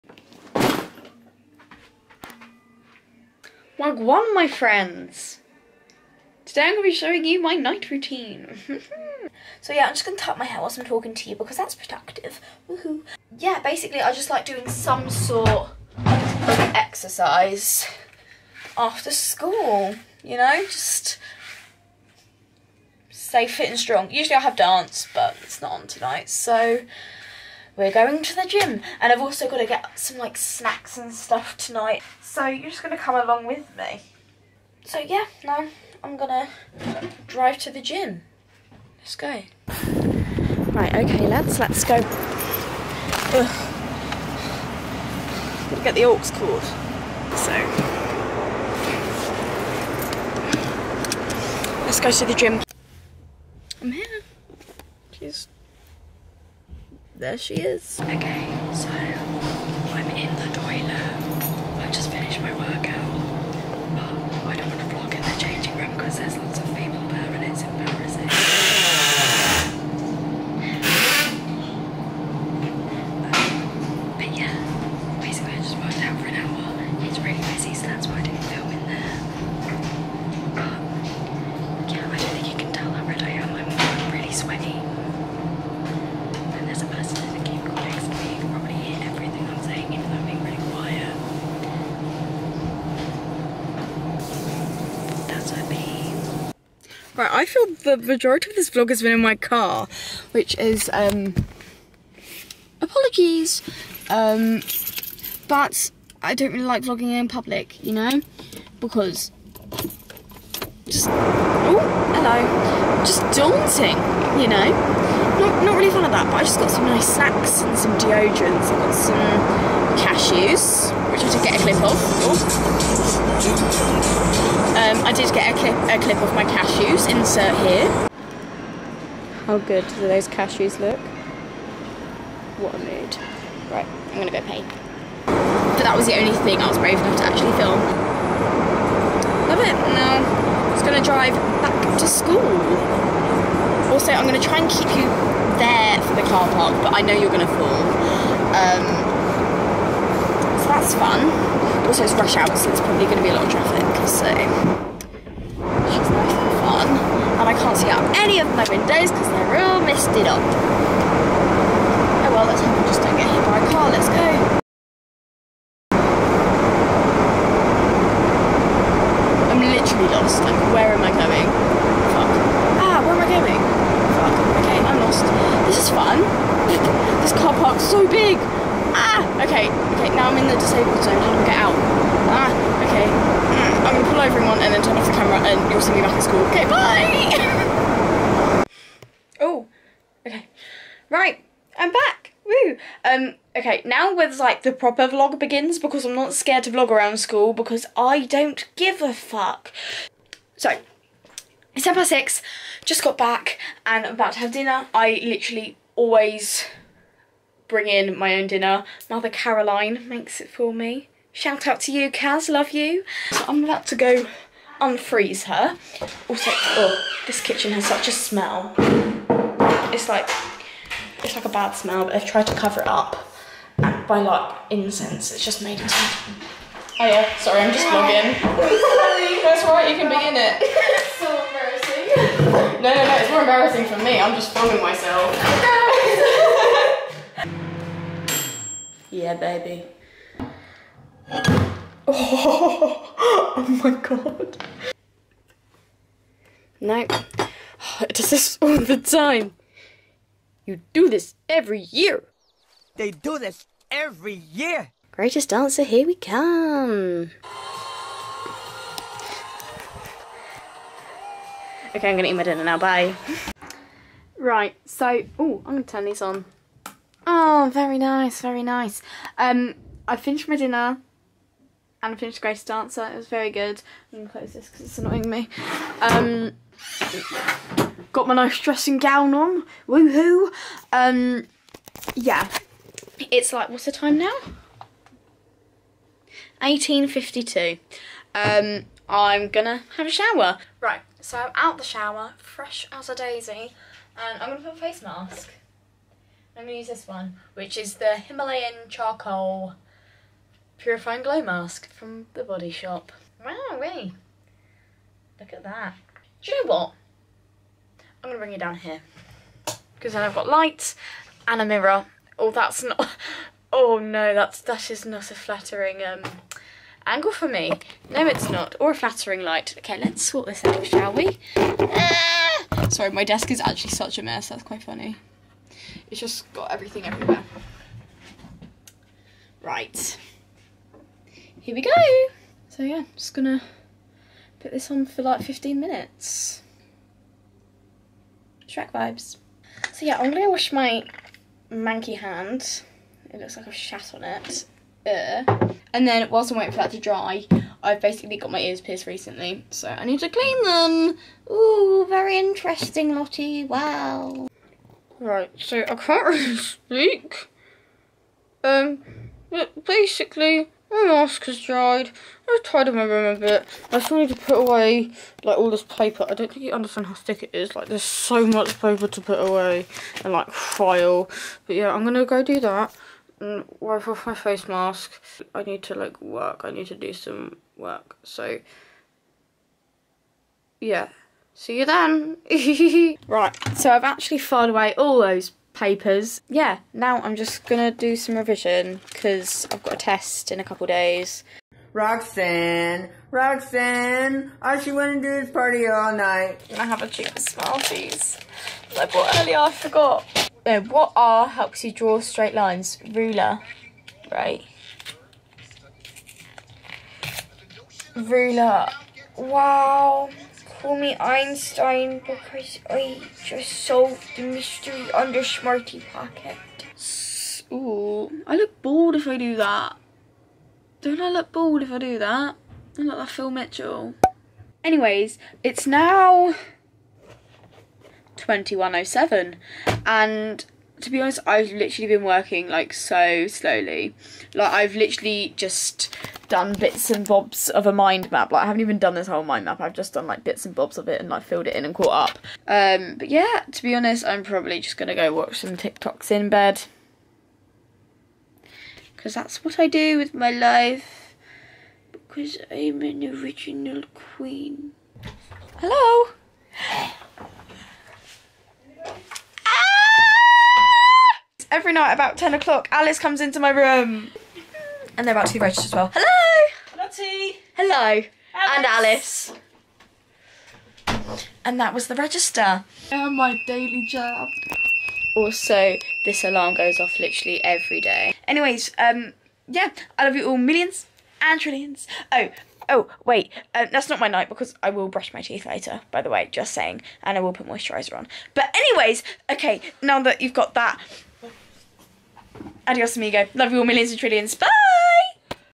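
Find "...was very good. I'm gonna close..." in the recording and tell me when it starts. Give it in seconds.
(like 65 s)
273 s.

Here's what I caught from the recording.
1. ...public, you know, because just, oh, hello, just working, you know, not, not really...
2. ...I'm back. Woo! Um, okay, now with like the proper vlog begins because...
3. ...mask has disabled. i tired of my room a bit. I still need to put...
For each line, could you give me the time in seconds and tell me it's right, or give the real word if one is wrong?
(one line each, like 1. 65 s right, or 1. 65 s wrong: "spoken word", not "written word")
1. 107 s wrong: "daunting", not "working"
2. 191 s right
3. 361 s wrong: "dried", not "disabled".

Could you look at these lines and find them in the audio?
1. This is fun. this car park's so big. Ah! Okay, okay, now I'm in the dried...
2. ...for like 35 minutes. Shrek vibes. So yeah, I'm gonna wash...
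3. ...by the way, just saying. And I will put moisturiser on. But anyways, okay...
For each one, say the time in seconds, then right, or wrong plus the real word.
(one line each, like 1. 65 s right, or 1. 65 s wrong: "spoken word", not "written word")
1. 175 s wrong: "disabled", not "dried"
2. 335 s wrong: "15", not "35"
3. 486 s right.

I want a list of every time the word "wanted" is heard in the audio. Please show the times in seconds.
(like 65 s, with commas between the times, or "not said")
394 s.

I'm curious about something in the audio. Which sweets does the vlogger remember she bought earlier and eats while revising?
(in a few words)
Smarties.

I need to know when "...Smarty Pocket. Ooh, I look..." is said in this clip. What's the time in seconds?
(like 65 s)
415 s.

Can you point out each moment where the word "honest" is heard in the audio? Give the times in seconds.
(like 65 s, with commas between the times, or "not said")
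431 s, 443 s.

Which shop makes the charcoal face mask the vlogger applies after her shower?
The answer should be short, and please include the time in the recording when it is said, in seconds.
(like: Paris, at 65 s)
The Body Shop, at 302 s.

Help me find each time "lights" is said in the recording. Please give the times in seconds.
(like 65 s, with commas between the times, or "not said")
310 s, 319 s.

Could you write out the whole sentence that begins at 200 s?
So, it's 10 past 6, just got back and I'm about to have dinner.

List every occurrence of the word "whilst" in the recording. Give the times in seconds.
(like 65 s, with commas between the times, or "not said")
10 s, 346 s.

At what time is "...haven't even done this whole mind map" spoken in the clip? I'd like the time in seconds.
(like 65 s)
438 s.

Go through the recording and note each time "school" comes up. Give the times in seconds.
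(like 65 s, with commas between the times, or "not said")
19 s, 142 s, 186 s, 197 s.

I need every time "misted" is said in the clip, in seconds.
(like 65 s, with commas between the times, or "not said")
159 s.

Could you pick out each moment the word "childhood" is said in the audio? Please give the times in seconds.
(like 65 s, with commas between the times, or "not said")
not said.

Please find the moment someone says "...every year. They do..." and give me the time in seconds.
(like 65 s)
251 s.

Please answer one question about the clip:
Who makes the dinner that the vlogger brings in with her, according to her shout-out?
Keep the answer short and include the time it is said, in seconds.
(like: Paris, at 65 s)
Mother Caroline, at 209 s.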